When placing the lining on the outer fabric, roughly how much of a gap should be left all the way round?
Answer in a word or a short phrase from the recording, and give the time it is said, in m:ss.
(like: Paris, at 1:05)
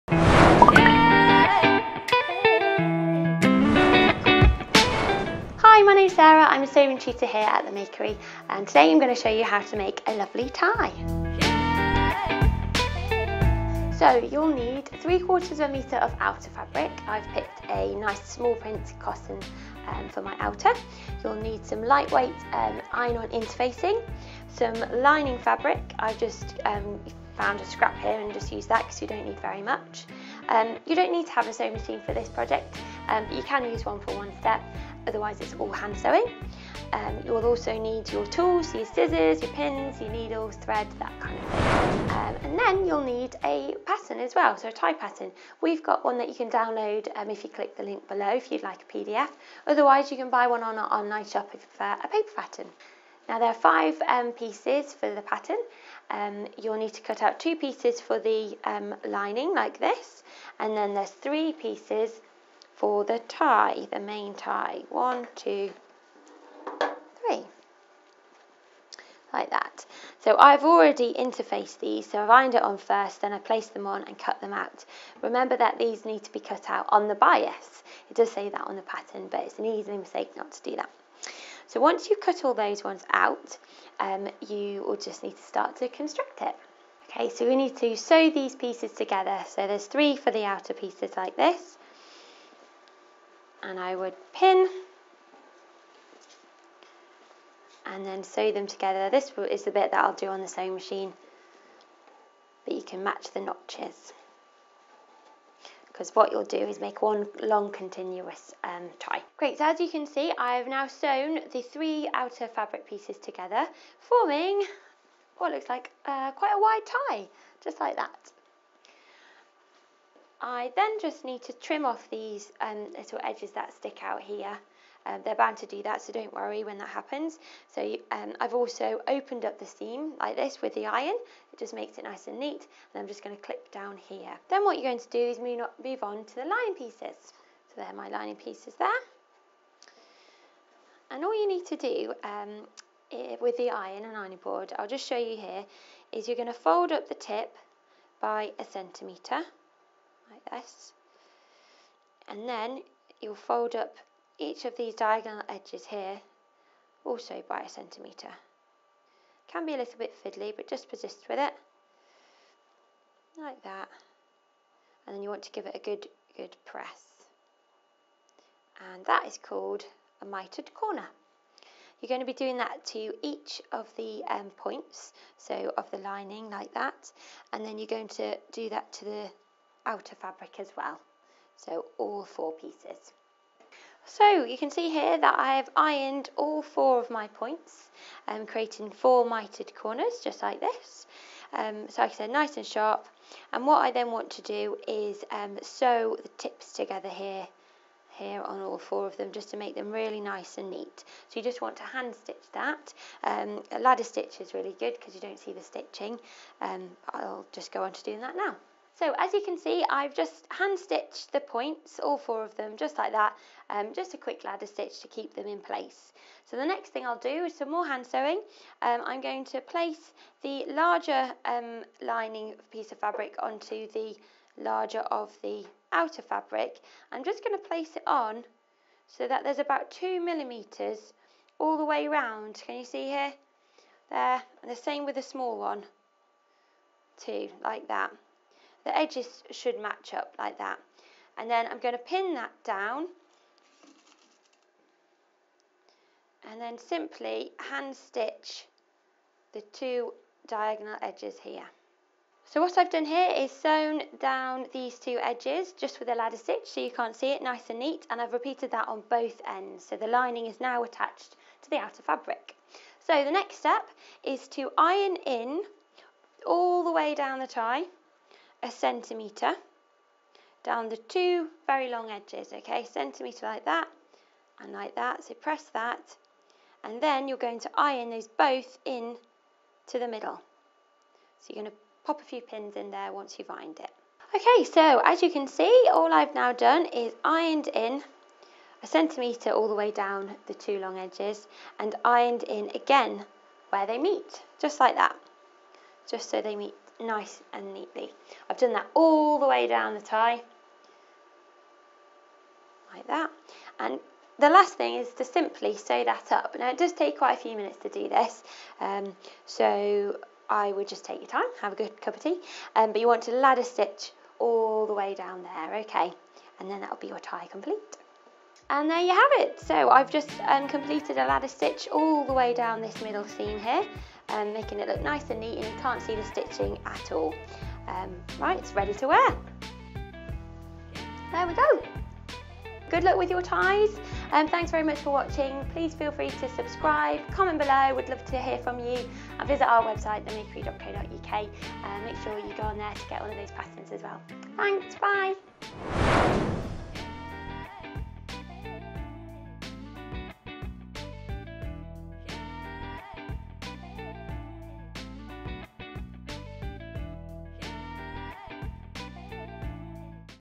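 2 millimetres, at 3:49.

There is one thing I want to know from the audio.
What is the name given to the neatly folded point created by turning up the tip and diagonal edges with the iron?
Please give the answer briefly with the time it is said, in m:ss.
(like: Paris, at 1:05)
Mitered corner, at 2:50.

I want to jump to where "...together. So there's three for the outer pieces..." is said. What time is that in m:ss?
1:28.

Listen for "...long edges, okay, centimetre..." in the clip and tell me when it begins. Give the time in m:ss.
4:31.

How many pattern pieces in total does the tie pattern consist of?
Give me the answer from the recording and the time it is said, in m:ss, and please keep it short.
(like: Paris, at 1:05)
5, at 0:53.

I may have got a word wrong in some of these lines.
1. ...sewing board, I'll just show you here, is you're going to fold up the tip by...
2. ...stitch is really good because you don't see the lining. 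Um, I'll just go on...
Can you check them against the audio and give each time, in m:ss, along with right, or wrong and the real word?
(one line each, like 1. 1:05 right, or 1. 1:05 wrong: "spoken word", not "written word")
1. 2:24 wrong: "ironing", not "sewing"
2. 3:24 wrong: "stitching", not "lining".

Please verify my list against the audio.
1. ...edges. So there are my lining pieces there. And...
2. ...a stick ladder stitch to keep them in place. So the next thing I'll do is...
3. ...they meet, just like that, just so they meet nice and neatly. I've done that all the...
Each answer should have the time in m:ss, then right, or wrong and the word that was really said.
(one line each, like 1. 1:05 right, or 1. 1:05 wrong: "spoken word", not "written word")
1. 2:16 wrong: "pieces", not "edges"
2. 3:34 wrong: "quick", not "stick"
3. 4:53 right.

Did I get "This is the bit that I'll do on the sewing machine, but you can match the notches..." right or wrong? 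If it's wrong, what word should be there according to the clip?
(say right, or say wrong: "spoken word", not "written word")
right.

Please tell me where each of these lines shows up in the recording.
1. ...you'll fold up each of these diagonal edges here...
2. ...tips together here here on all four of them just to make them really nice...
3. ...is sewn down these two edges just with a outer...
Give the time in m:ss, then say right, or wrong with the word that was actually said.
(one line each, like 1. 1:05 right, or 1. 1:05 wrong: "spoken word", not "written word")
1. 2:33 right
2. 3:16 right
3. 4:13 wrong: "ladder", not "outer".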